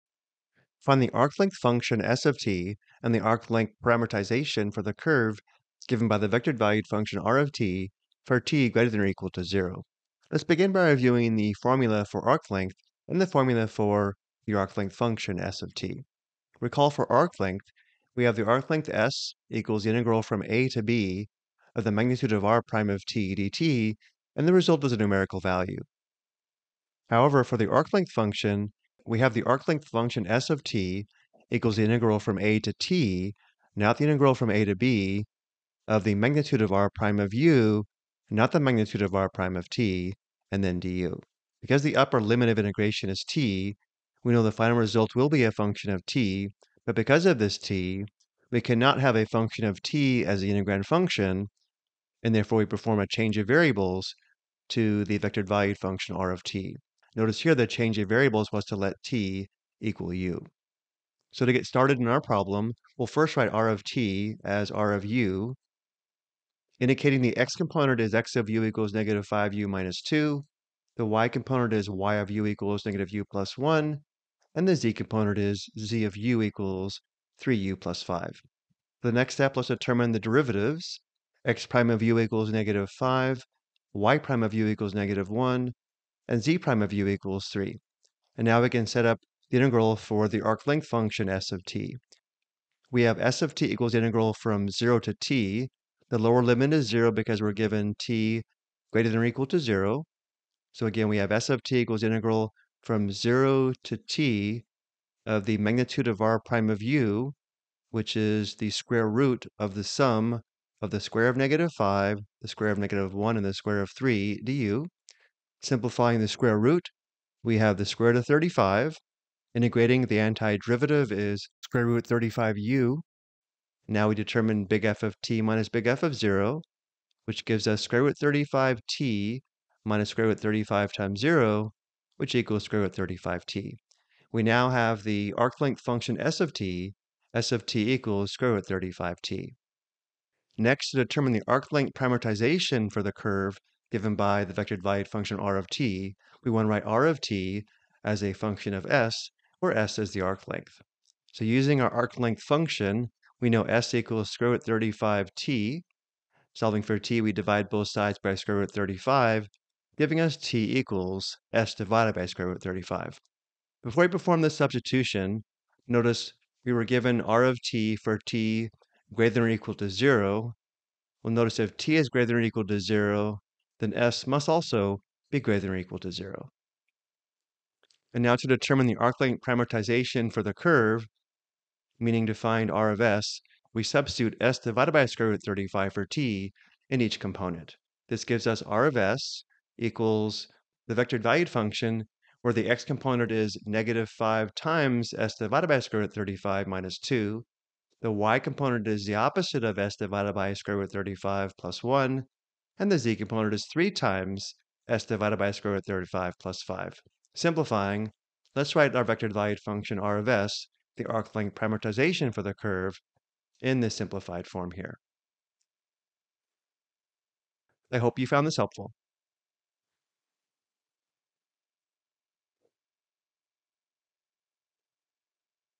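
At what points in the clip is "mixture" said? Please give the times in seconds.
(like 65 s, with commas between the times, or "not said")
not said.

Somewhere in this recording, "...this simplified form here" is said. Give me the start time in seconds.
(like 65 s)
213 s.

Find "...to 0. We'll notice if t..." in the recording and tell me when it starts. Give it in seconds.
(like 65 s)
169 s.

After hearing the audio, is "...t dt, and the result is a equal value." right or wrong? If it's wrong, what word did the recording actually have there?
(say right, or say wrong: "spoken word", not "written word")
wrong: "numerical", not "equal".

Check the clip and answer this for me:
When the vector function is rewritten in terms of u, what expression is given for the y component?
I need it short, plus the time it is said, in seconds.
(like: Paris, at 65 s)
-u + 1, at 72 s.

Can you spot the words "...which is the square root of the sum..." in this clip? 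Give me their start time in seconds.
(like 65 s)
107 s.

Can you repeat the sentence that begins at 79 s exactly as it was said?
The next step, let's determine the derivatives.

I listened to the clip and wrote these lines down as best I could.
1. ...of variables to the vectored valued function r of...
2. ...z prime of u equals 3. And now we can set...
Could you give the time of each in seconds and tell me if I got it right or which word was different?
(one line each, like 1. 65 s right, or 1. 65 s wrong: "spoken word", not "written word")
1. 53 s right
2. 86 s right.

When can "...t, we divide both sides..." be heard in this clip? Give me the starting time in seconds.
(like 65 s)
156 s.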